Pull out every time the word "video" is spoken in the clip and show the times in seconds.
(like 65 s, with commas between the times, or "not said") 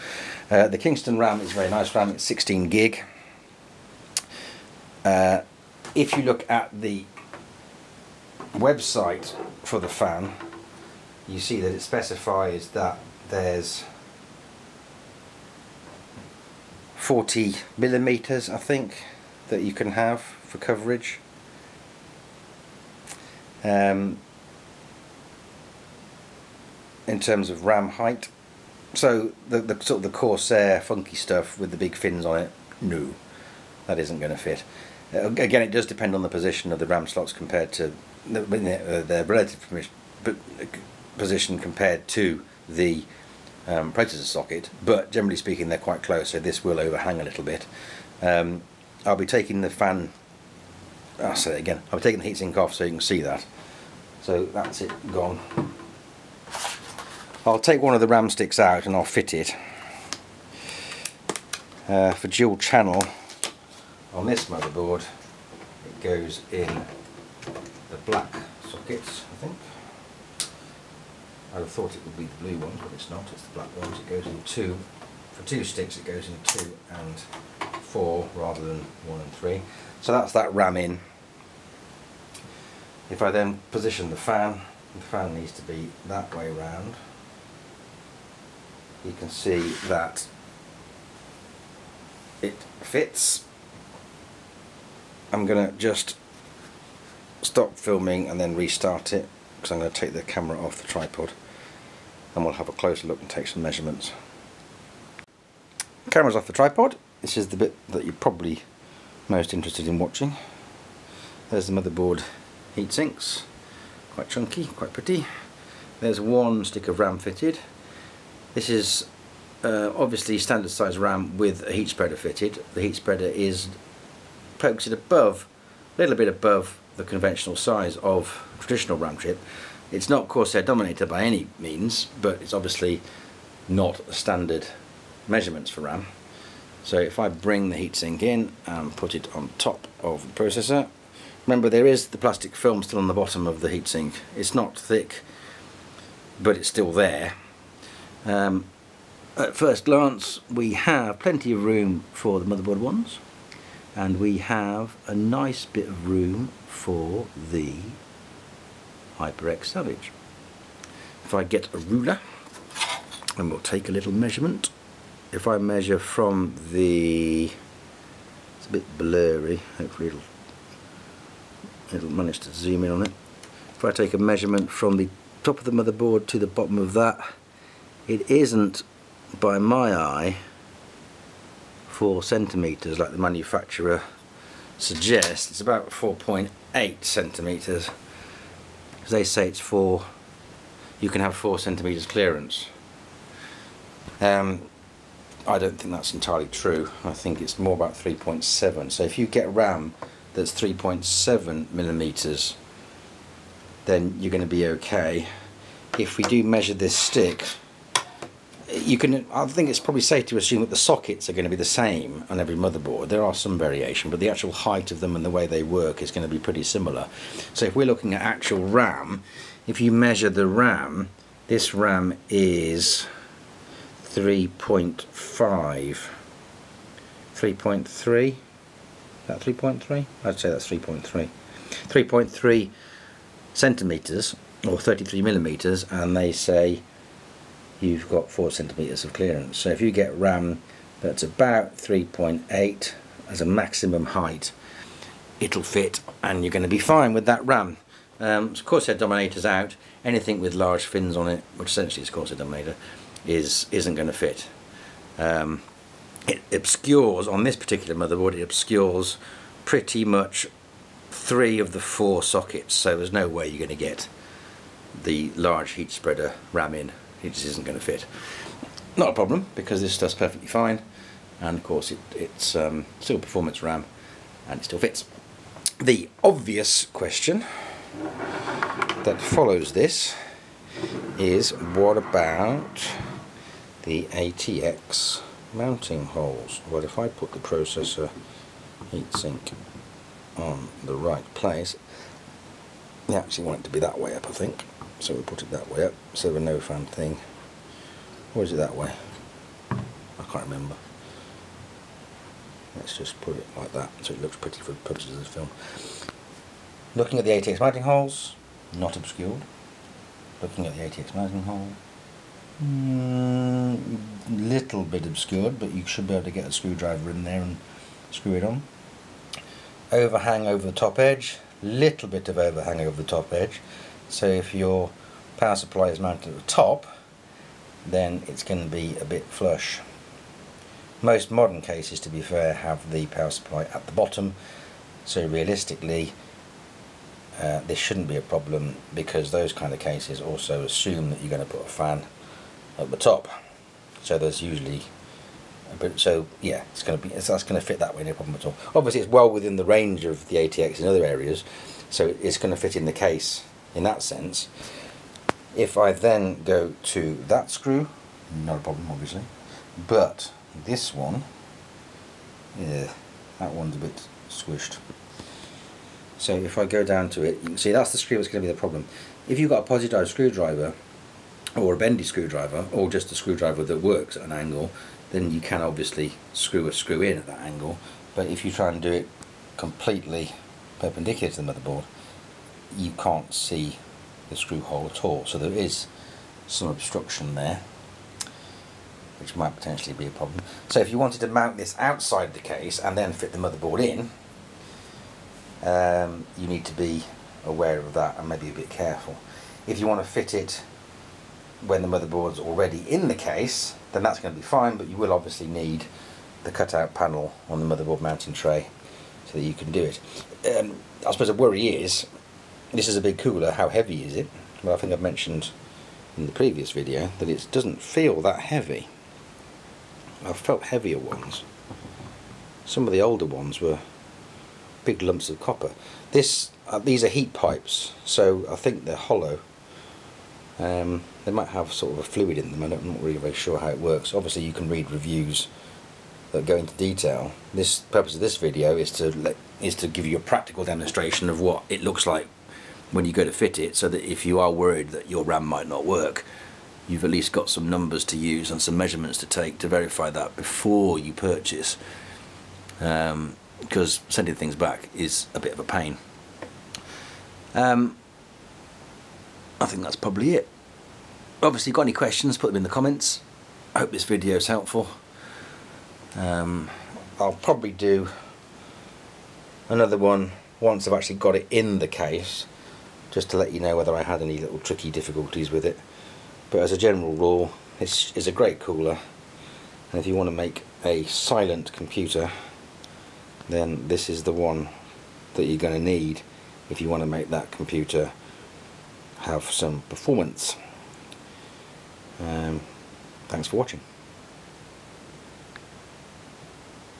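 416 s, 438 s, 464 s.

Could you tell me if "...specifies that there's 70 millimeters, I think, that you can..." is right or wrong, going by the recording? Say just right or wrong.
wrong.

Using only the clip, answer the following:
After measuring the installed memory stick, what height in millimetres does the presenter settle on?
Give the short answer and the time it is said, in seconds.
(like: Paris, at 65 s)
33 millimetres, at 234 s.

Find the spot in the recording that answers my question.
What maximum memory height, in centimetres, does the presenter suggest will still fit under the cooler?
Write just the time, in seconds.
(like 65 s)
241 s.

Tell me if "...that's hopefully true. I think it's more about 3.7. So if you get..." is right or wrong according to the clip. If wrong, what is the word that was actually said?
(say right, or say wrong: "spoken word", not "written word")
wrong: "entirely", not "hopefully".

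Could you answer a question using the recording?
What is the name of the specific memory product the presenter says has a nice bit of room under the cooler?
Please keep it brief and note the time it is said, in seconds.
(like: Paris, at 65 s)
HyperX Savage, at 159 s.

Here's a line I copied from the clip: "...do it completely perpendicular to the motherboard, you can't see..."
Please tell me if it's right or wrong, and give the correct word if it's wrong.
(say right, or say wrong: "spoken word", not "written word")
right.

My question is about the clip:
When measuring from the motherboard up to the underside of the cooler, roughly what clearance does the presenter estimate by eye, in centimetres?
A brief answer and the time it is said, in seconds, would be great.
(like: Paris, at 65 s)
4.8 centimeters, at 185 s.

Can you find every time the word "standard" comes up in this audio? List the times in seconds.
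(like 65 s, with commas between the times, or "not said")
120 s, 134 s.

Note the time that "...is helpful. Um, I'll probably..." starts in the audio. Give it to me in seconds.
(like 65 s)
464 s.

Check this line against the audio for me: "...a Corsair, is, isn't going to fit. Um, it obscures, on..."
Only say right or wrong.
wrong.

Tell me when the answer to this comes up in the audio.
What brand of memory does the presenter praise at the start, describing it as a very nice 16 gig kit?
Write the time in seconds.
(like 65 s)
0 s.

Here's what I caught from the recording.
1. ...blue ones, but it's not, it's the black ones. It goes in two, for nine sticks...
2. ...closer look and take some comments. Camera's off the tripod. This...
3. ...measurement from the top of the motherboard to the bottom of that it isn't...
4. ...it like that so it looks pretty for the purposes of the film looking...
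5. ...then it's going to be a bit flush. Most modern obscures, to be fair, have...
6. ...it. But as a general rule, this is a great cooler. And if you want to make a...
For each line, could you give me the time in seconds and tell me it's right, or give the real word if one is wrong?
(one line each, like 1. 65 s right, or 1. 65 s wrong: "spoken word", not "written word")
1. 72 s wrong: "two", not "nine"
2. 102 s wrong: "measurements", not "comments"
3. 174 s right
4. 303 s right
5. 327 s wrong: "cases", not "obscures"
6. 475 s right.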